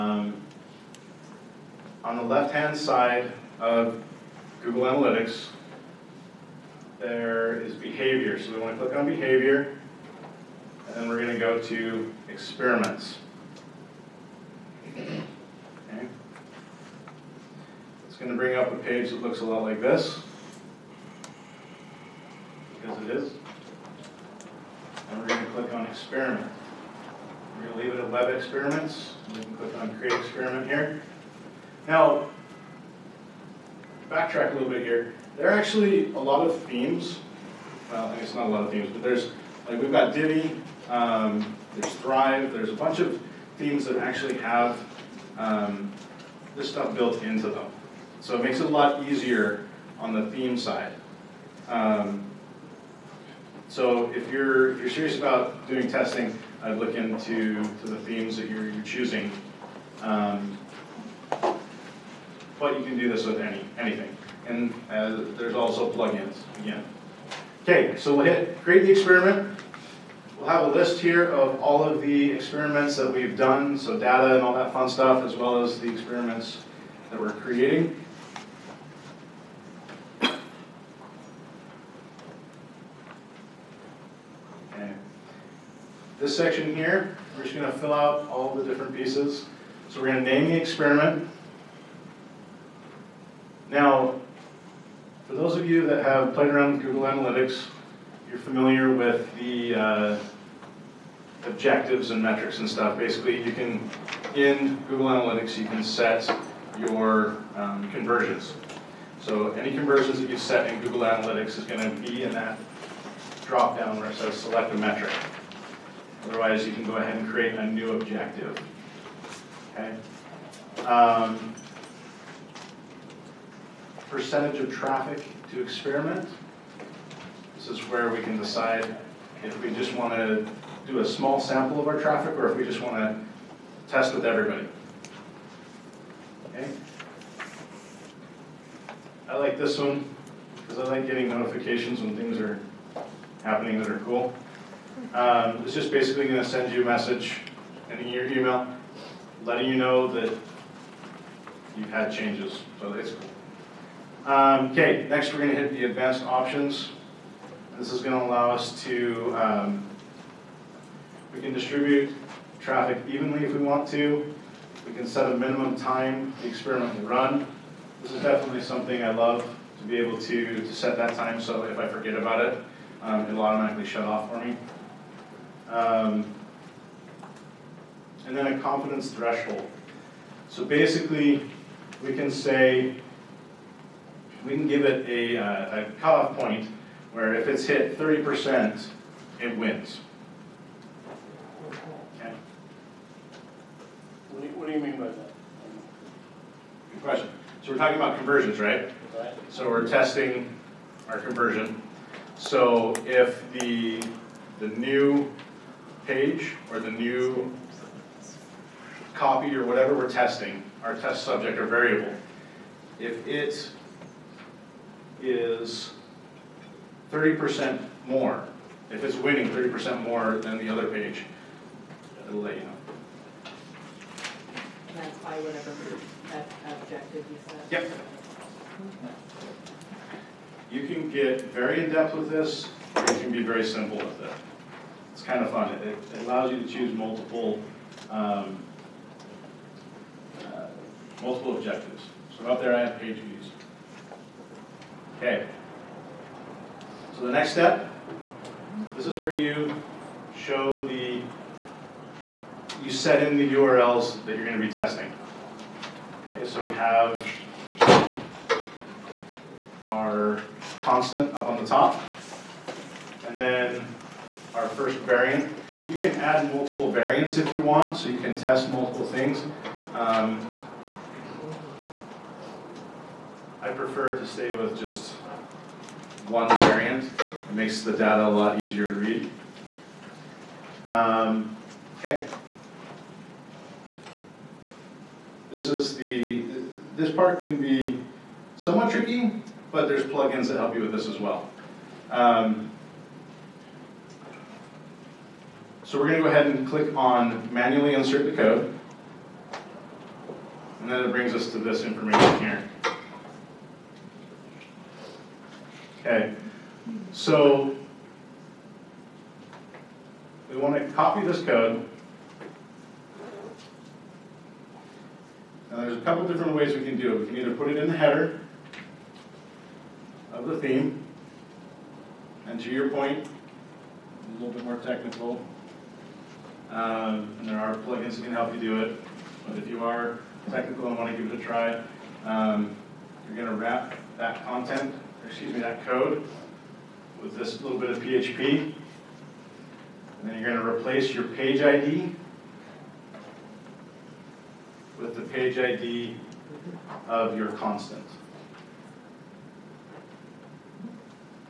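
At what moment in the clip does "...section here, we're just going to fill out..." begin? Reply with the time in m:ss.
1:26.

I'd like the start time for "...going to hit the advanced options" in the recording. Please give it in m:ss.
2:35.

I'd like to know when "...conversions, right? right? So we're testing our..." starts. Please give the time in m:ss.
3:18.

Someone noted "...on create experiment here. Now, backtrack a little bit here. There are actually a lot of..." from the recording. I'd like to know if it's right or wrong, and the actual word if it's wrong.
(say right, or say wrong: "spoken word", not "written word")
right.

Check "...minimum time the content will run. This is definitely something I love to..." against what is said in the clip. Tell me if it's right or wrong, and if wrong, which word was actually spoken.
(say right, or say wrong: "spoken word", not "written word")
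wrong: "experiment", not "content".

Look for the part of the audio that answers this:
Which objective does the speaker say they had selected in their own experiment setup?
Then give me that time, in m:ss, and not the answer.
4:02.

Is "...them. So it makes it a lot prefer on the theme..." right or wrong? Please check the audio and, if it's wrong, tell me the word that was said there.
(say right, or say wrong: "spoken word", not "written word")
wrong: "easier", not "prefer".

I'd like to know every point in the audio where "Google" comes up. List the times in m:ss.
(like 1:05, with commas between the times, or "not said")
0:04, 1:36, 1:44, 1:50.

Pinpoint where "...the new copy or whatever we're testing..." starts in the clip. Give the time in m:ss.
3:26.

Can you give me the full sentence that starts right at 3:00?
So basically, we can say we can give it a, uh, a cutoff point where if it's hit 30%, it wins.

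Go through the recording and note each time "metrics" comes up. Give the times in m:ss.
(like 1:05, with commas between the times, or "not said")
1:42, 1:54.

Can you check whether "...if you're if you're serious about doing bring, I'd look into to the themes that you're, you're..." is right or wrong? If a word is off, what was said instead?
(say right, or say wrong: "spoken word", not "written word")
wrong: "testing", not "bring".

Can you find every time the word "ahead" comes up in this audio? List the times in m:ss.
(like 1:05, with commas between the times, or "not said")
1:56, 4:56.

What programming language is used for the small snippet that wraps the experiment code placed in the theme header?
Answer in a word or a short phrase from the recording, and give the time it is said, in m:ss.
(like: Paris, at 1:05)
PHP, at 5:37.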